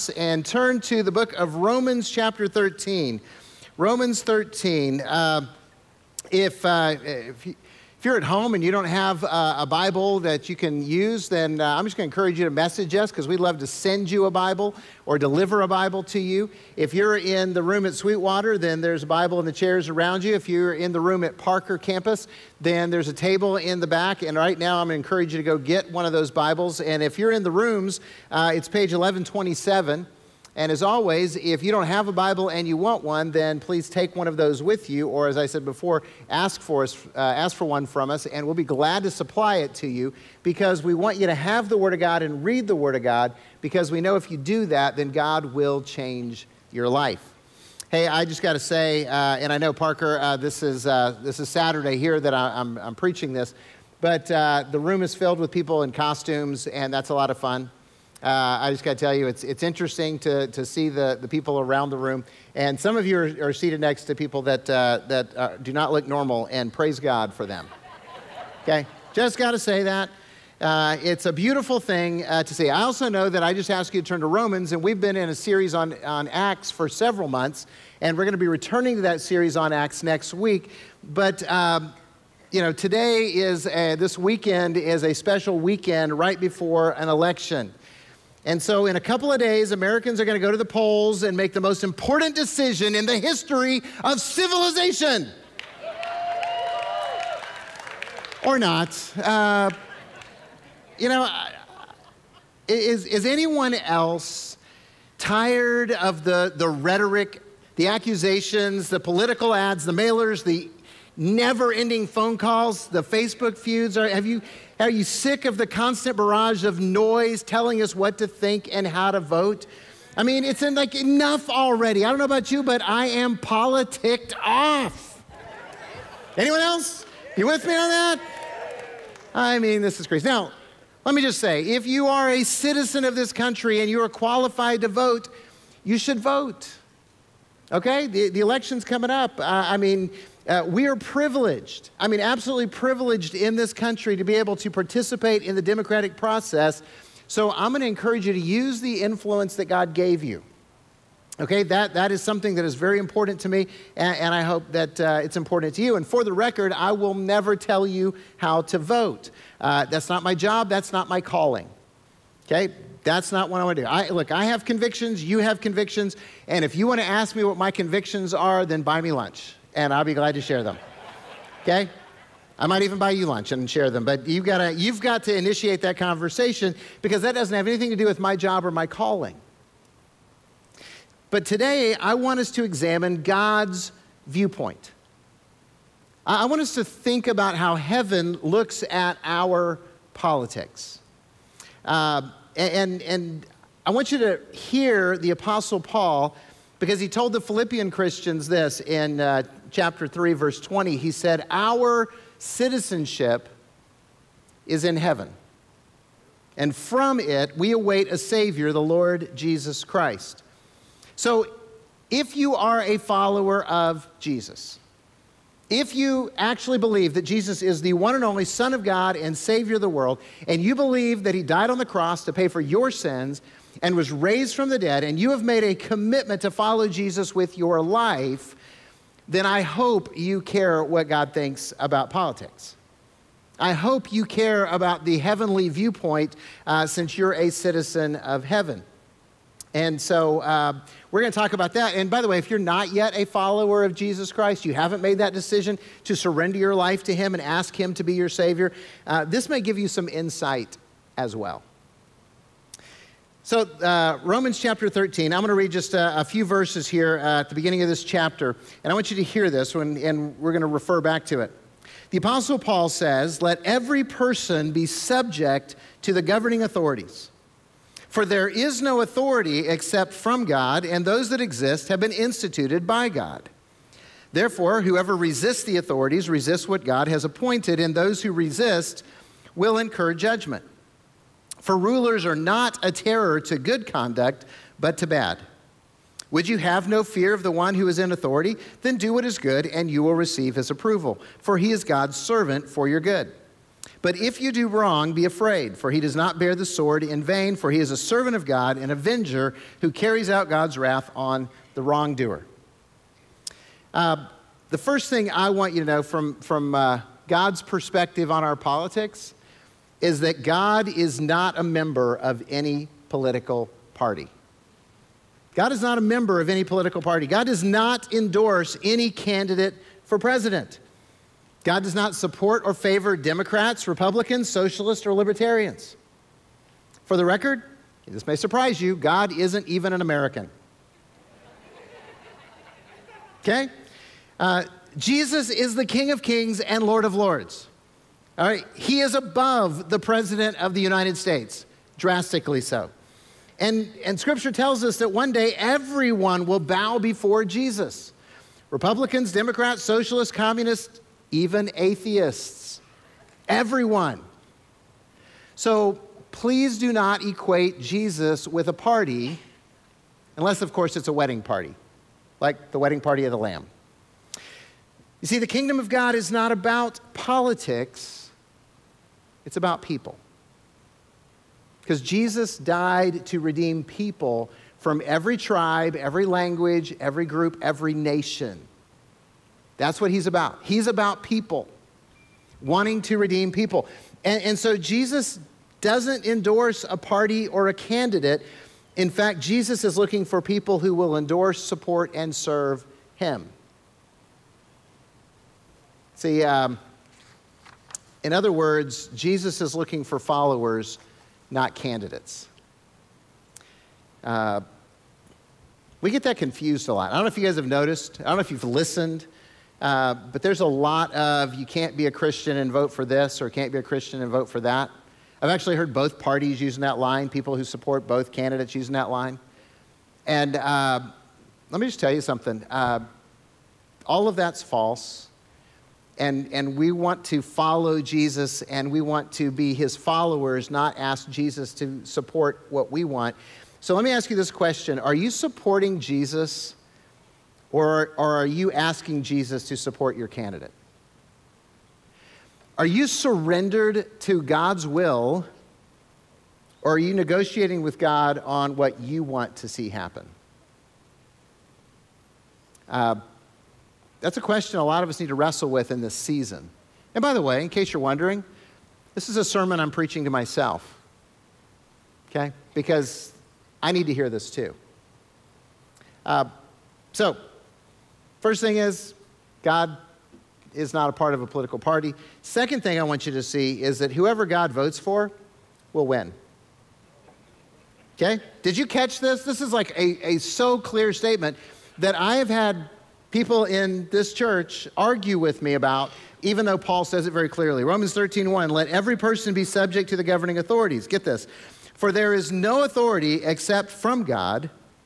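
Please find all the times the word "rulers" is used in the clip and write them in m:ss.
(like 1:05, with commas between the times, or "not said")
4:41.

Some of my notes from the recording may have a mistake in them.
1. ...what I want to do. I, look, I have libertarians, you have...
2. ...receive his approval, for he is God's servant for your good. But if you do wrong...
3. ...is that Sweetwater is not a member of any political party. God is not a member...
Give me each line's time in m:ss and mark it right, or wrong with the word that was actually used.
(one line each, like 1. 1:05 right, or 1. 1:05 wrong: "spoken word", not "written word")
1. 2:43 wrong: "convictions", not "libertarians"
2. 4:50 right
3. 5:10 wrong: "God", not "Sweetwater".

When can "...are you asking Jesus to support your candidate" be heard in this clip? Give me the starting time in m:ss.
7:18.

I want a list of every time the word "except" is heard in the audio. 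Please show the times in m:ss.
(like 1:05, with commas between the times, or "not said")
4:29, 8:13.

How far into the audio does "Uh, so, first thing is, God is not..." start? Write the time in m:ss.
7:46.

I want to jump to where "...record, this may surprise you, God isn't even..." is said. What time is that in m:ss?
5:27.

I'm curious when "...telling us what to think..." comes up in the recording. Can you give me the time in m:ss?
1:57.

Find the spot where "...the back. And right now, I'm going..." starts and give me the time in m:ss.
0:23.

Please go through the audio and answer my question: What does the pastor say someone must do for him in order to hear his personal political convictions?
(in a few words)
buy me lunch.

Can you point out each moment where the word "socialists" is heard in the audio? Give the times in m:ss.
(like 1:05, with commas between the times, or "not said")
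5:24, 5:49.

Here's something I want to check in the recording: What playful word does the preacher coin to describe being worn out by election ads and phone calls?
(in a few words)
politicked off.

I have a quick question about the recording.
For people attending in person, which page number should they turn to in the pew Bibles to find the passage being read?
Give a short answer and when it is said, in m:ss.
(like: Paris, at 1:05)
1127, at 0:28.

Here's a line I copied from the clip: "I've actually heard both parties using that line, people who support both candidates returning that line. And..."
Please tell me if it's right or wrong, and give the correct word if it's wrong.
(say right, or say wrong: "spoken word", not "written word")
wrong: "using", not "returning".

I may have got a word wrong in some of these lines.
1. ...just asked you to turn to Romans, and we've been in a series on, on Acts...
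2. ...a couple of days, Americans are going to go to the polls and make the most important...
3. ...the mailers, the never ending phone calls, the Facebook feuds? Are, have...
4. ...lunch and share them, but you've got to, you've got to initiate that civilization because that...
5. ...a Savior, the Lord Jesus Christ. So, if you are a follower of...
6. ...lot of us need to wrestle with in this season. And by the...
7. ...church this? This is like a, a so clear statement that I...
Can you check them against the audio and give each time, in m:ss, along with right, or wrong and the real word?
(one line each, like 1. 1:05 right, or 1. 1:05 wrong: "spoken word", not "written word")
1. 1:13 right
2. 1:28 right
3. 1:49 right
4. 2:53 wrong: "conversation", not "civilization"
5. 3:28 right
6. 7:34 right
7. 7:58 wrong: "catch", not "church".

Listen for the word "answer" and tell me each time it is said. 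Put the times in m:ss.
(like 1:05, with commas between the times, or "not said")
not said.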